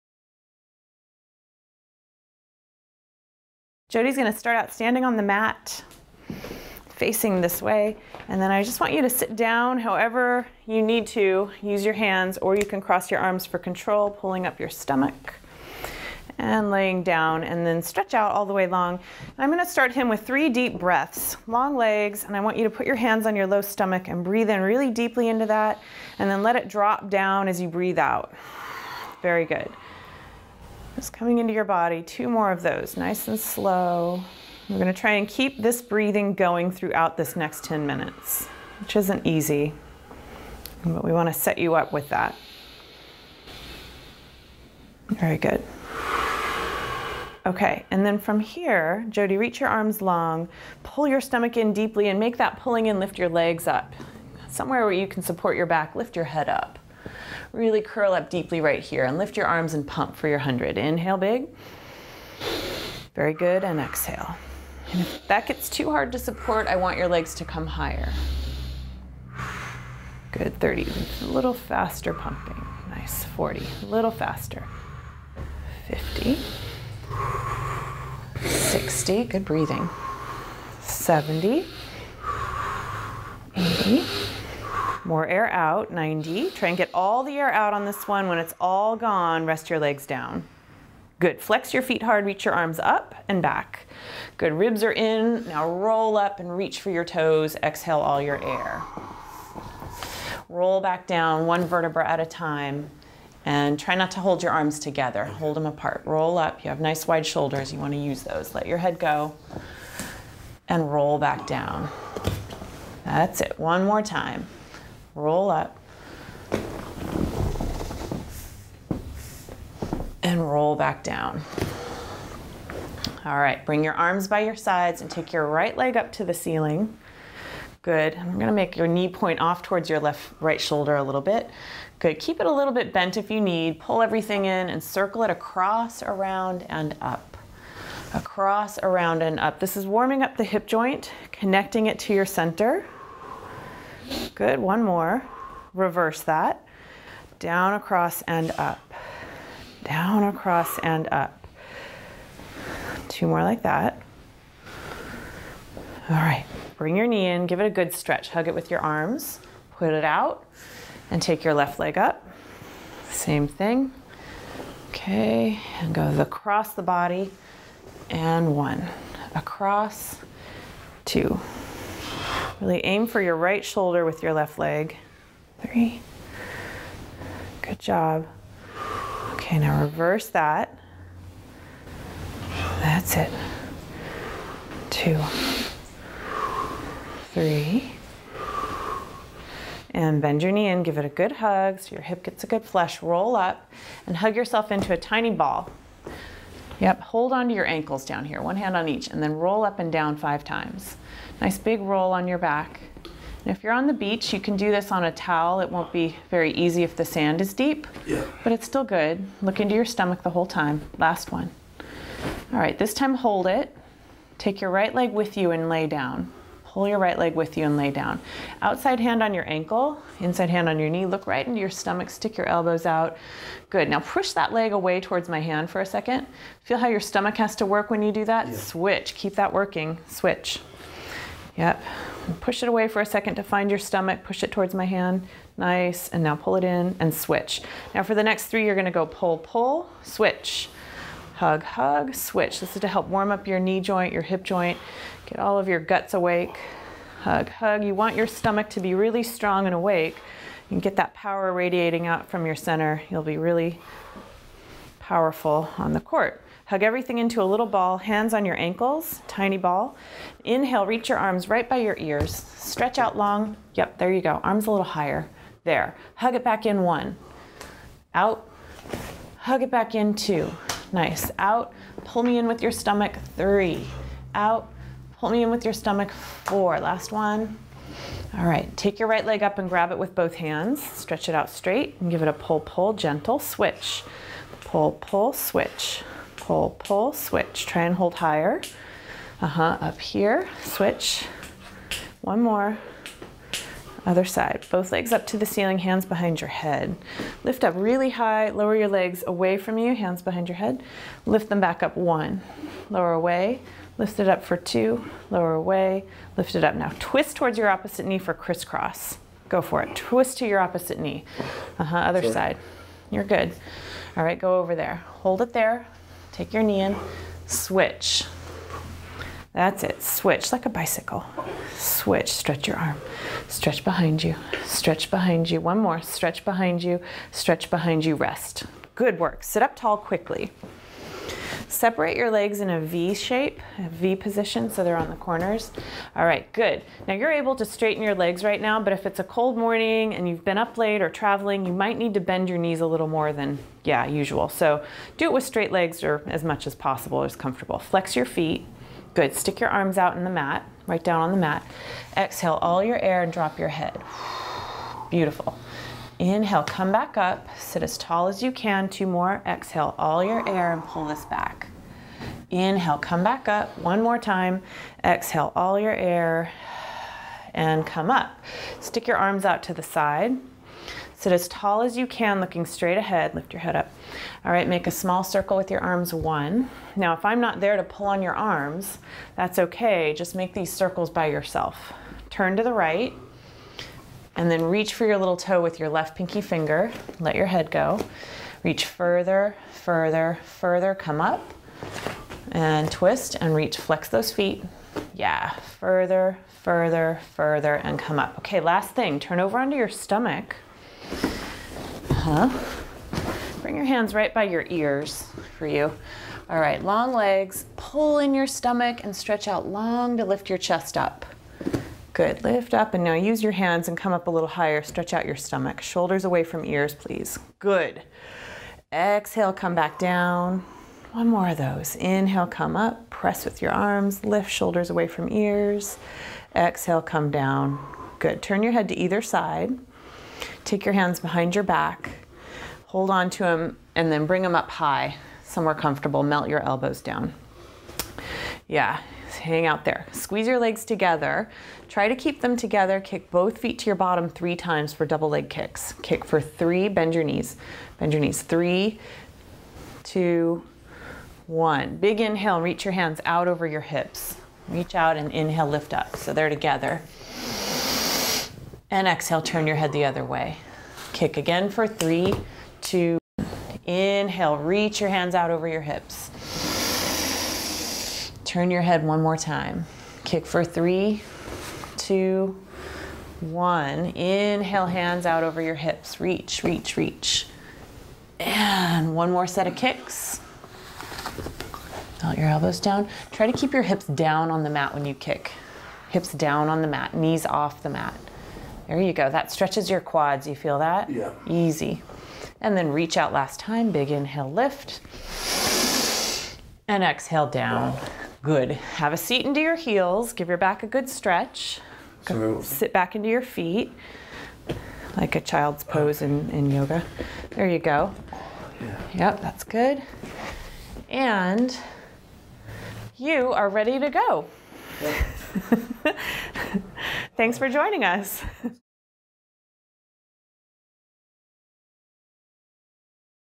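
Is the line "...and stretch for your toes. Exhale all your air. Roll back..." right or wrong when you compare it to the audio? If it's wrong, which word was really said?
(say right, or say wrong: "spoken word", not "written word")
wrong: "reach", not "stretch".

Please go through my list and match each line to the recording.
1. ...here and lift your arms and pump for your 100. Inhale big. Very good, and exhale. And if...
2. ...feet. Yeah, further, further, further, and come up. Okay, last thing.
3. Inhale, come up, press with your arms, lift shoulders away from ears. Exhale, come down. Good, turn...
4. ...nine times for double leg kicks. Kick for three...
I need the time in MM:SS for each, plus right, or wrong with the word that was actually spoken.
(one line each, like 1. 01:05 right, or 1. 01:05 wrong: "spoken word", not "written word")
1. 00:58 right
2. 06:34 right
3. 07:01 right
4. 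07:24 wrong: "three", not "nine".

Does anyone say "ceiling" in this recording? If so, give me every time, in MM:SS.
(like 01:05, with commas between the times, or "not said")
02:06, 04:55.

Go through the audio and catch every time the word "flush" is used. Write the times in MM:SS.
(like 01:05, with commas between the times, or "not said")
03:12.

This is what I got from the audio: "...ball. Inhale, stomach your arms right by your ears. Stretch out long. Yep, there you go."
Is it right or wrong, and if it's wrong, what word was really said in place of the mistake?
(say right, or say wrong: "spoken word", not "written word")
wrong: "reach", not "stomach".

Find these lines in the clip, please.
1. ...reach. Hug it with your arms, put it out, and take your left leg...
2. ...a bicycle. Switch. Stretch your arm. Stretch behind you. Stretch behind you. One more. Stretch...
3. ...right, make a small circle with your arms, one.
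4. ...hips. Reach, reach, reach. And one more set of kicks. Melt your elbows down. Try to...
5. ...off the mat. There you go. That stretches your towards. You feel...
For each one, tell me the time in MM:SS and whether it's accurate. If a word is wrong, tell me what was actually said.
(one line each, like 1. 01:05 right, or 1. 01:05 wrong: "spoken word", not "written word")
1. 02:37 wrong: "stretch", not "reach"
2. 05:20 right
3. 06:14 right
4. 07:55 right
5. 08:07 wrong: "quads", not "towards".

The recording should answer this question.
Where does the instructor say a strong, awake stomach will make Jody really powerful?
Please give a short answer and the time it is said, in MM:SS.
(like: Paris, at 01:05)
on the court, at 04:15.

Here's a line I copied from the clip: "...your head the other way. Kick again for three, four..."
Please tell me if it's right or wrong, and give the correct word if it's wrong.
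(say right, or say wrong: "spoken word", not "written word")
wrong: "two", not "four".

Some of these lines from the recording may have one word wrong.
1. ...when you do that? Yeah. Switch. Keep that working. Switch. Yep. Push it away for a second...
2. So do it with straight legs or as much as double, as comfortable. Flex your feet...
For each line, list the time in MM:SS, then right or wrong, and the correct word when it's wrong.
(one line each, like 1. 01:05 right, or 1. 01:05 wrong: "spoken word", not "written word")
1. 03:47 right
2. 05:44 wrong: "possible", not "double".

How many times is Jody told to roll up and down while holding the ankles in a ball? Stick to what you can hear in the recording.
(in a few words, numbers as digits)
5.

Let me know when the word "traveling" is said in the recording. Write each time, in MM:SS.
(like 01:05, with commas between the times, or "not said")
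05:41.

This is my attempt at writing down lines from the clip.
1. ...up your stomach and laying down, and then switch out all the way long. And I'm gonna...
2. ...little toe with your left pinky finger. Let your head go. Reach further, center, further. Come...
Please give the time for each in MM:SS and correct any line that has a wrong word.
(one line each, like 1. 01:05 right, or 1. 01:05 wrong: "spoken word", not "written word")
1. 00:14 wrong: "stretch", not "switch"
2. 06:25 wrong: "further", not "center".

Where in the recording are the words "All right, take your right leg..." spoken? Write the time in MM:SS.
04:38.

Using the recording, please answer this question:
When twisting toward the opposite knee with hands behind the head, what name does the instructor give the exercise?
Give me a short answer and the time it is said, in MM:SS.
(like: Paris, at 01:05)
crisscross, at 05:08.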